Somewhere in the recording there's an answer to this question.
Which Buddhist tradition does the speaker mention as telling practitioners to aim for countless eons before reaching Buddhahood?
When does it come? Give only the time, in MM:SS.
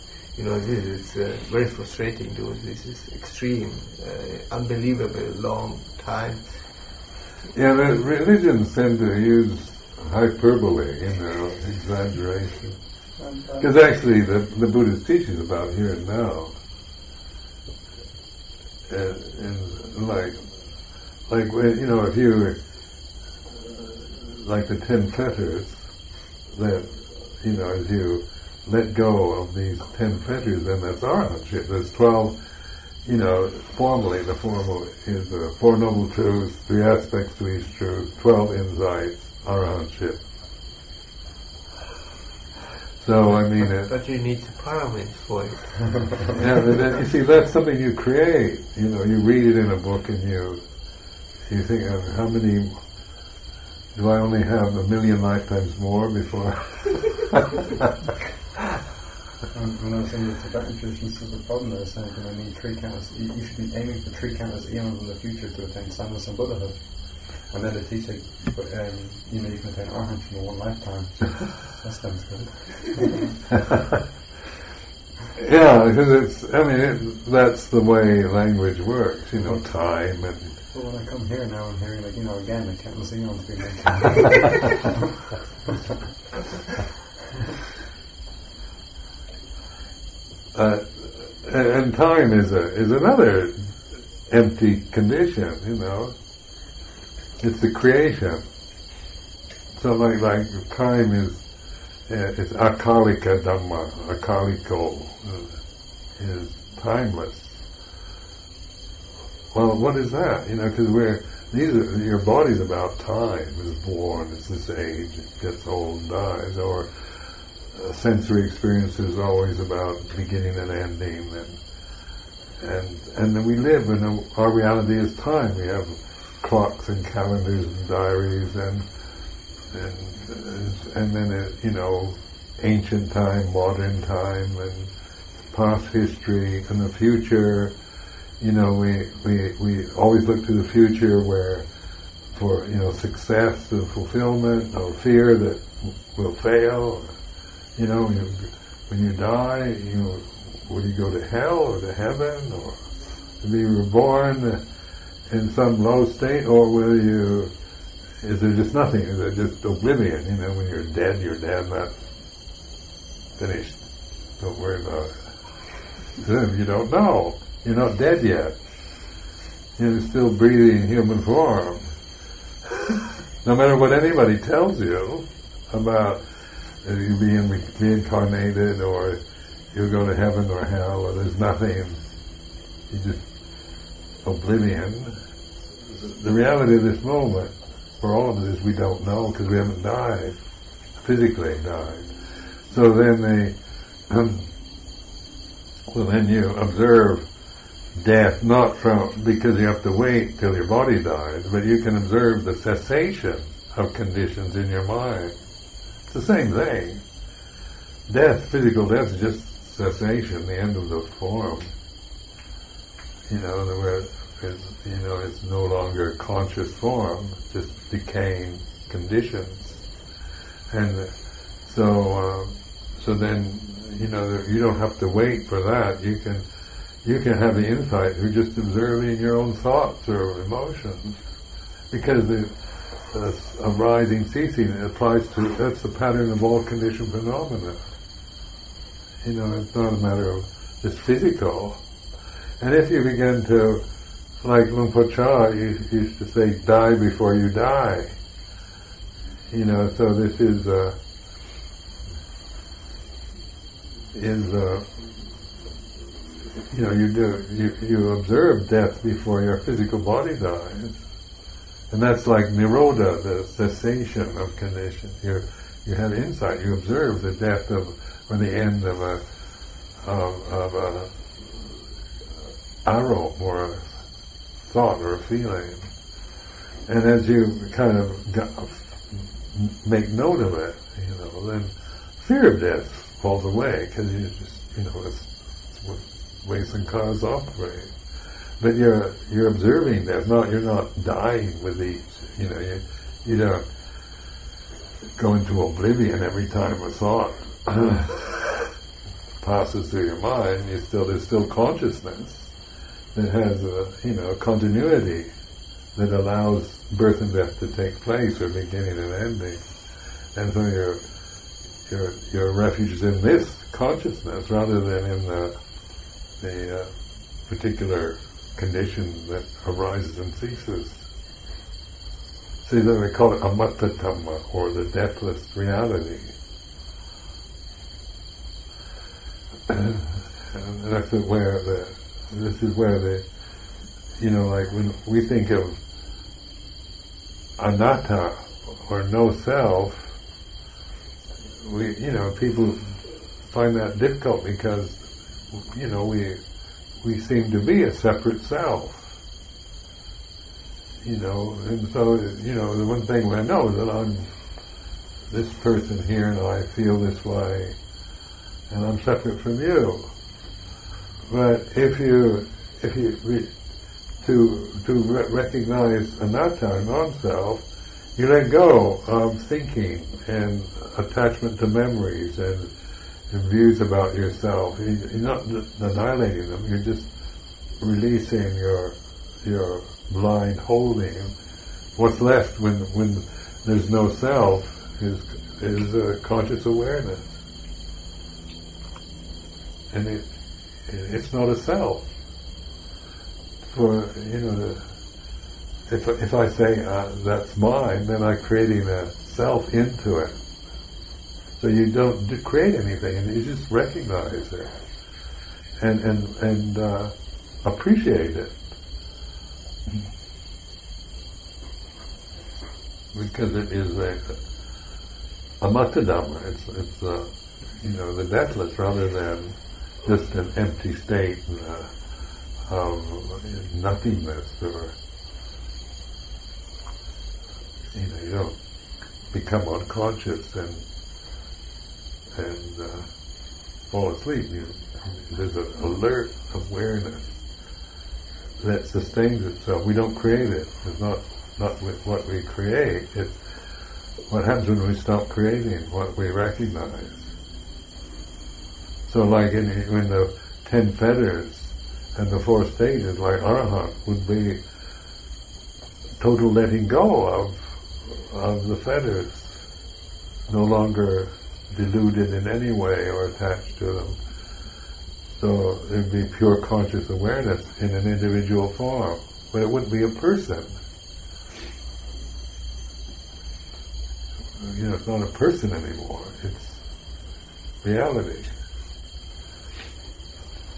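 01:00.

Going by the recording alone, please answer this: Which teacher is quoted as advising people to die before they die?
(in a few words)
Luang Por Chah.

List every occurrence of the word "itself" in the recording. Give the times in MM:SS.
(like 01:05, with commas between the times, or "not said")
07:19.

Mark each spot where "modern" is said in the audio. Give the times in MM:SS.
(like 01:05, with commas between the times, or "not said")
02:13.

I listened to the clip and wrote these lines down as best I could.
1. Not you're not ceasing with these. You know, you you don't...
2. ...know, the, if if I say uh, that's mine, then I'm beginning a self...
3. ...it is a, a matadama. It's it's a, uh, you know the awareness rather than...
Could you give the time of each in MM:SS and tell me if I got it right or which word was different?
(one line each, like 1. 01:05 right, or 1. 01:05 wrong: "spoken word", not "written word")
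1. 04:50 wrong: "dying", not "ceasing"
2. 06:34 wrong: "creating", not "beginning"
3. 06:53 wrong: "deathless", not "awareness".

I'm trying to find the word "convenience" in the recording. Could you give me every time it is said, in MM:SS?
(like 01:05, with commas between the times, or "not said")
not said.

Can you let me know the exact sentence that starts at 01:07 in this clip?
And then the teacher, but um, you know you can attain arahant in one lifetime.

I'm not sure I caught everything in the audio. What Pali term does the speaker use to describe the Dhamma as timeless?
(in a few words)
akalika dhamma.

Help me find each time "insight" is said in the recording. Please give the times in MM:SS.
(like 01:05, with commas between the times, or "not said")
00:38, 03:47, 04:26.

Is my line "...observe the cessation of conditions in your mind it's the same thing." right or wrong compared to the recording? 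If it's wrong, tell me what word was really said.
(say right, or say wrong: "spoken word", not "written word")
right.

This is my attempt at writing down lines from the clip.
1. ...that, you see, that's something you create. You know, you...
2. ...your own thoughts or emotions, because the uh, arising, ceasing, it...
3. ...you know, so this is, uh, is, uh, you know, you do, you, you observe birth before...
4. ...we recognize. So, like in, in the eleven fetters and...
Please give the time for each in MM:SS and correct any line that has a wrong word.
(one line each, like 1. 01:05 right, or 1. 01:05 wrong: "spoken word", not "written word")
1. 00:46 right
2. 03:49 right
3. 04:09 wrong: "death", not "birth"
4. 07:26 wrong: "ten", not "eleven".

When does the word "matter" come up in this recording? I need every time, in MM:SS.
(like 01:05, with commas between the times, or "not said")
02:53, 03:59.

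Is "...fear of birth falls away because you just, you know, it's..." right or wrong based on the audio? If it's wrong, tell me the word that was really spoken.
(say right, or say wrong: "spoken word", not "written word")
wrong: "death", not "birth".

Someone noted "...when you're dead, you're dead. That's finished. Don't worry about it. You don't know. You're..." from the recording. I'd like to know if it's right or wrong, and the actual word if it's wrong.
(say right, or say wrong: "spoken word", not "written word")
right.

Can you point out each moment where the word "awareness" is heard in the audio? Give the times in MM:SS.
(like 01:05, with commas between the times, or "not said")
06:26, 07:16, 07:47.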